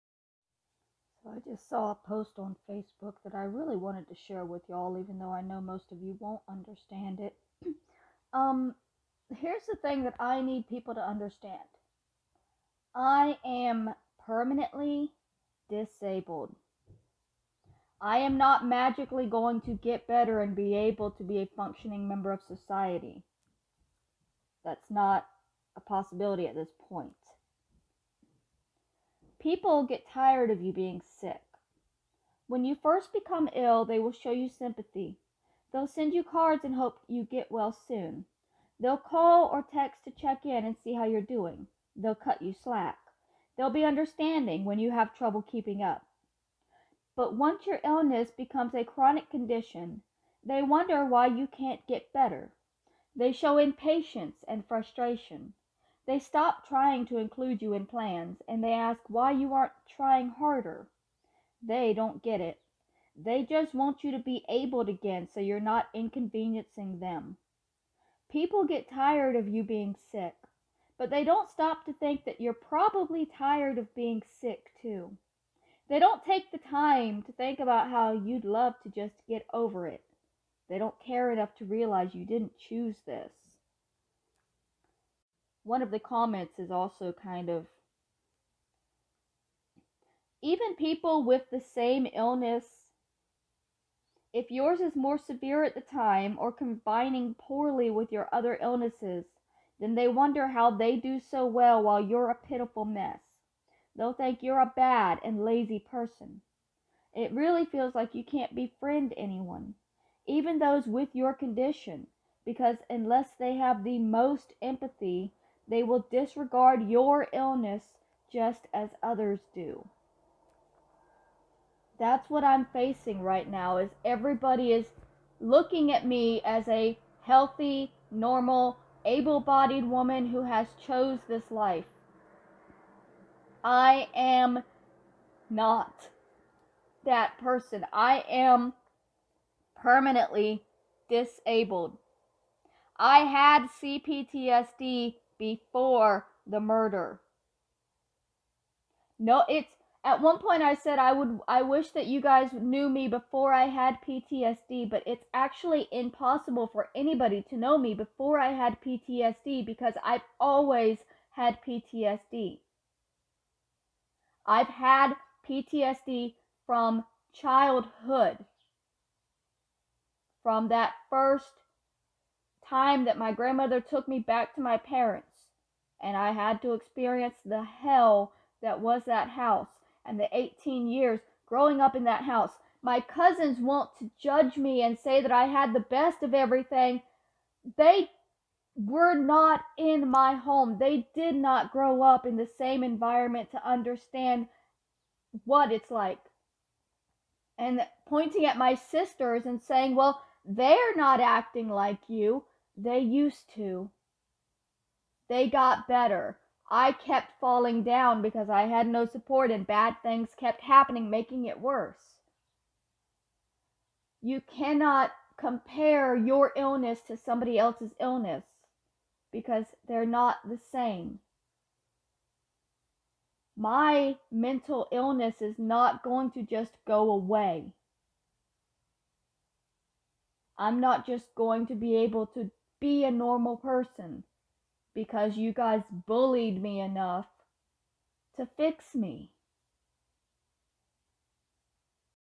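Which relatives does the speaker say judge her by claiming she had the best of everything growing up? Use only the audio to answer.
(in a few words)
Cousins.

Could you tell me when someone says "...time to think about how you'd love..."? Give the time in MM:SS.
01:16.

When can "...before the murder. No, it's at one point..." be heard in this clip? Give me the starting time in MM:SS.
02:25.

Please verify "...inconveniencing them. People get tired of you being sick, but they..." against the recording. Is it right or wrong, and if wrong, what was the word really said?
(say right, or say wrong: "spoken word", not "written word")
right.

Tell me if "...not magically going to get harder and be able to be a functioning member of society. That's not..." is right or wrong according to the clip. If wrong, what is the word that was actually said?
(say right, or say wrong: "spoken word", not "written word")
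wrong: "better", not "harder".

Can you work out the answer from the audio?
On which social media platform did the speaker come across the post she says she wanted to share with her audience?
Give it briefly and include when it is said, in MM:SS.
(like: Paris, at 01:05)
Facebook, at 00:02.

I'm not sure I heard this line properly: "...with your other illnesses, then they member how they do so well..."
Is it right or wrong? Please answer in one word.
wrong.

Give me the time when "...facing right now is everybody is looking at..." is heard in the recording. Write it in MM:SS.
02:02.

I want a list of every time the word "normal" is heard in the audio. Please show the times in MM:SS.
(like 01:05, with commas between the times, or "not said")
02:08, 03:53.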